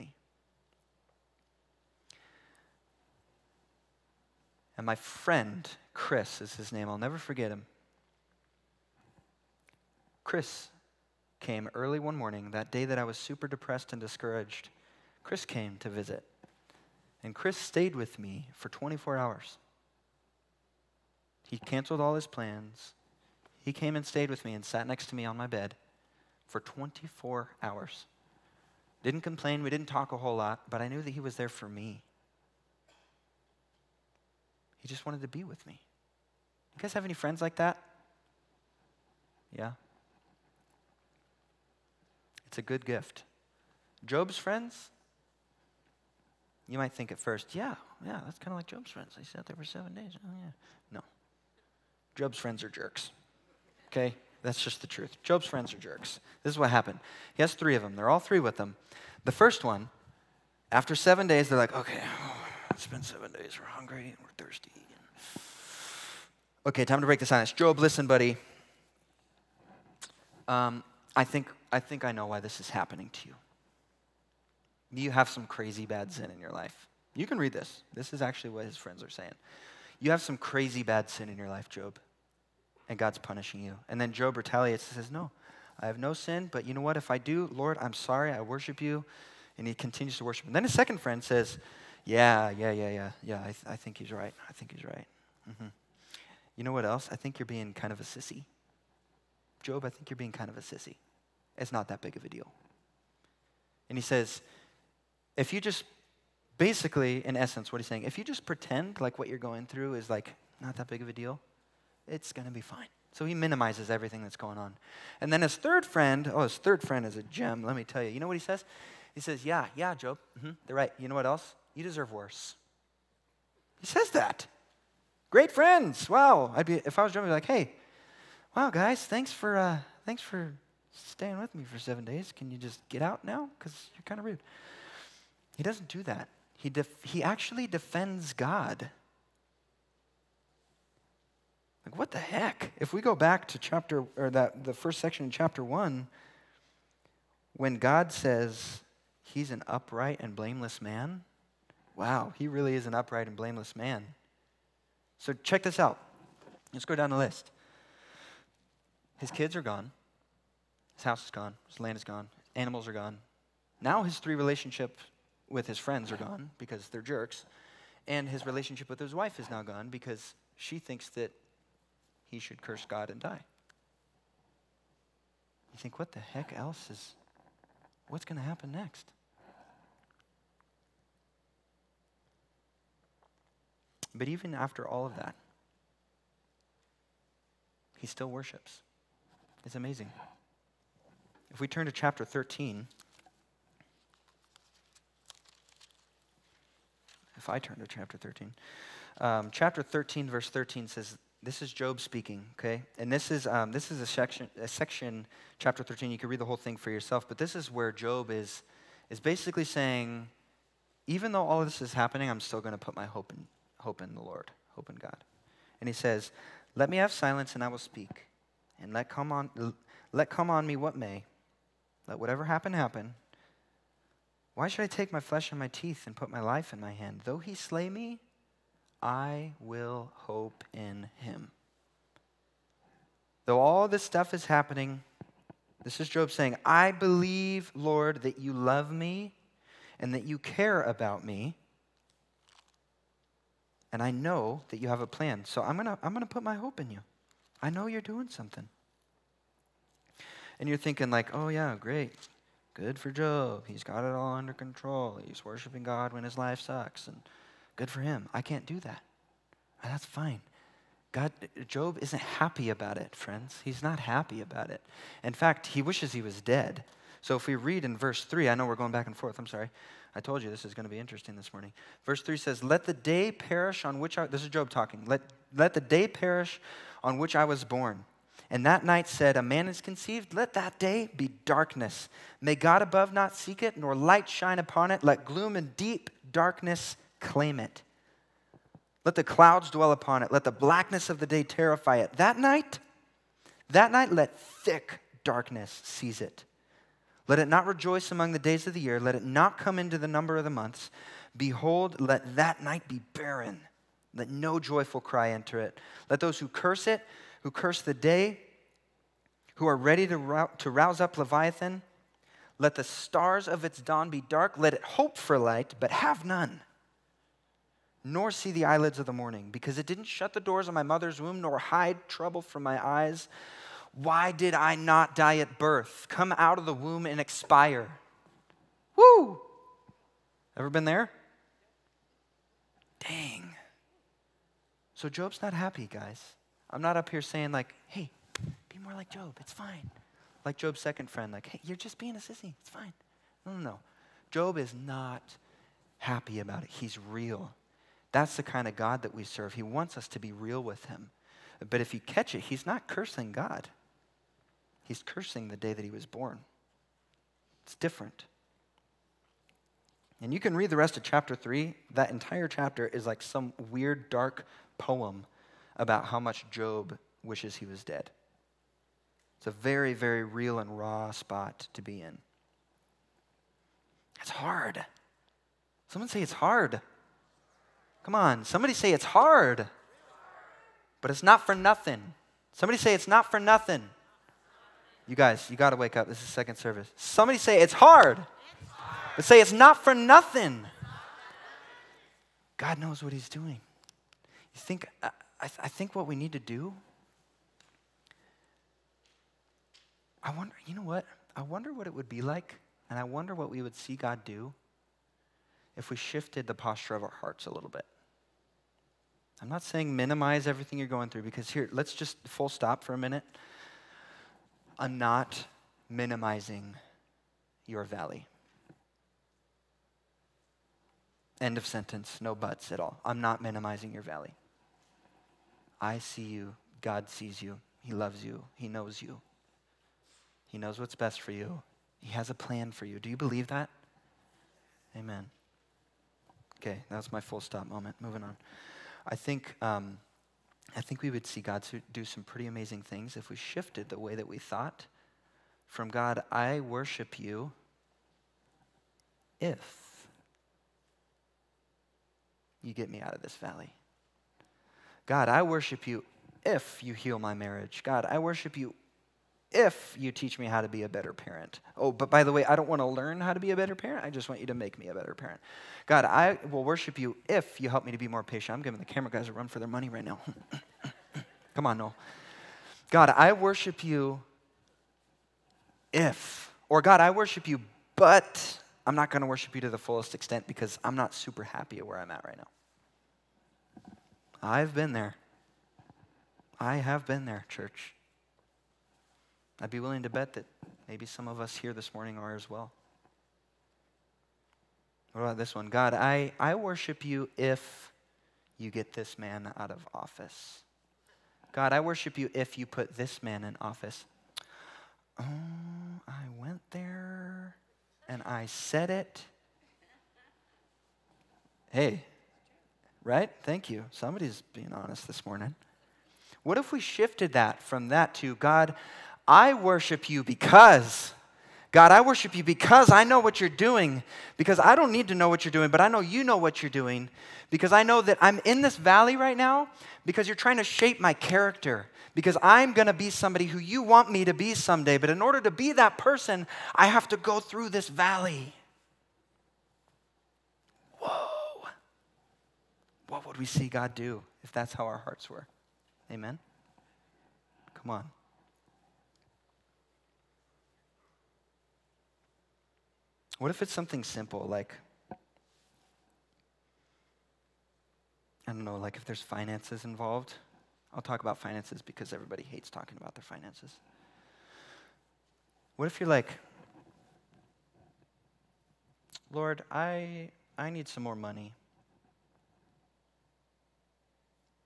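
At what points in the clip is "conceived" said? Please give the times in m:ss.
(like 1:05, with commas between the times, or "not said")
4:39.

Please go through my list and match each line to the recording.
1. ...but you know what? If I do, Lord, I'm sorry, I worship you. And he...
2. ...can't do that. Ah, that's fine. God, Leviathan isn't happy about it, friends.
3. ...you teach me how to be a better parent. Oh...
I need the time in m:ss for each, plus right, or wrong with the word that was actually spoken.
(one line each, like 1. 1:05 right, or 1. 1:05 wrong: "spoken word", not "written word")
1. 1:26 right
2. 4:18 wrong: "Job", not "Leviathan"
3. 7:39 right.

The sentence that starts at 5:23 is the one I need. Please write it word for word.
Why did I not die at birth, come out of the womb and expire?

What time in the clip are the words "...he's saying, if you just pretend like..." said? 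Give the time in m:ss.
1:47.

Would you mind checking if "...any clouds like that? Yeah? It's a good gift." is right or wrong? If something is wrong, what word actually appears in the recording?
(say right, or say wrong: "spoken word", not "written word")
wrong: "friends", not "clouds".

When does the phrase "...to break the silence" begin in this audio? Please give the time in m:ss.
1:07.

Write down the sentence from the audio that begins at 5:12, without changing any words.
Let the stars of its dawn be dark.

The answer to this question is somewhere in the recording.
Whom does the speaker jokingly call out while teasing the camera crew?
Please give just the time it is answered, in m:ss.
7:51.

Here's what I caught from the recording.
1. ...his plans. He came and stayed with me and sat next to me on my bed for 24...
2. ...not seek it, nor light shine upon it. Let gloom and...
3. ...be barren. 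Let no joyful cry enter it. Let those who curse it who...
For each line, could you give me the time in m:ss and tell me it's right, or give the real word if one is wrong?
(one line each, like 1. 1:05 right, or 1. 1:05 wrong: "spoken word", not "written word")
1. 0:22 right
2. 4:43 right
3. 5:02 right.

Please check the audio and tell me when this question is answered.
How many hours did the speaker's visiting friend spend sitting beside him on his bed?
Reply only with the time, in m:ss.
0:17.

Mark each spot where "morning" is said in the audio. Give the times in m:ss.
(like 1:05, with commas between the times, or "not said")
0:12, 4:31, 5:19, 8:11, 8:35.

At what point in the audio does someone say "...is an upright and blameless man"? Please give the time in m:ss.
2:32.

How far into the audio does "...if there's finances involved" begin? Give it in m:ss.
9:18.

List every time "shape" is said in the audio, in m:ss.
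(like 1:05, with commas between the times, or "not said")
8:50.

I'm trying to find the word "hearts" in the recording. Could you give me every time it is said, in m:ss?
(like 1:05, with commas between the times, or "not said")
6:47, 9:04.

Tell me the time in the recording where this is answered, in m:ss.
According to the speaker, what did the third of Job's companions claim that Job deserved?
2:01.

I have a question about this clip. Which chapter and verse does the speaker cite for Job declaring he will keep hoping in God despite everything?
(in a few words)
Chapter 13, verse 13.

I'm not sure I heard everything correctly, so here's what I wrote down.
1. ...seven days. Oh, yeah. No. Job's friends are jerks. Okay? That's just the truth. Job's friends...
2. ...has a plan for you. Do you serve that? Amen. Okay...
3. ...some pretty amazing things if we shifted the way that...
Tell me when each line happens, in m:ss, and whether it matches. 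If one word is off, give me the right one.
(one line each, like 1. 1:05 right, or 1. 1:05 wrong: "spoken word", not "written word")
1. 0:49 right
2. 7:12 wrong: "believe", not "serve"
3. 7:22 right.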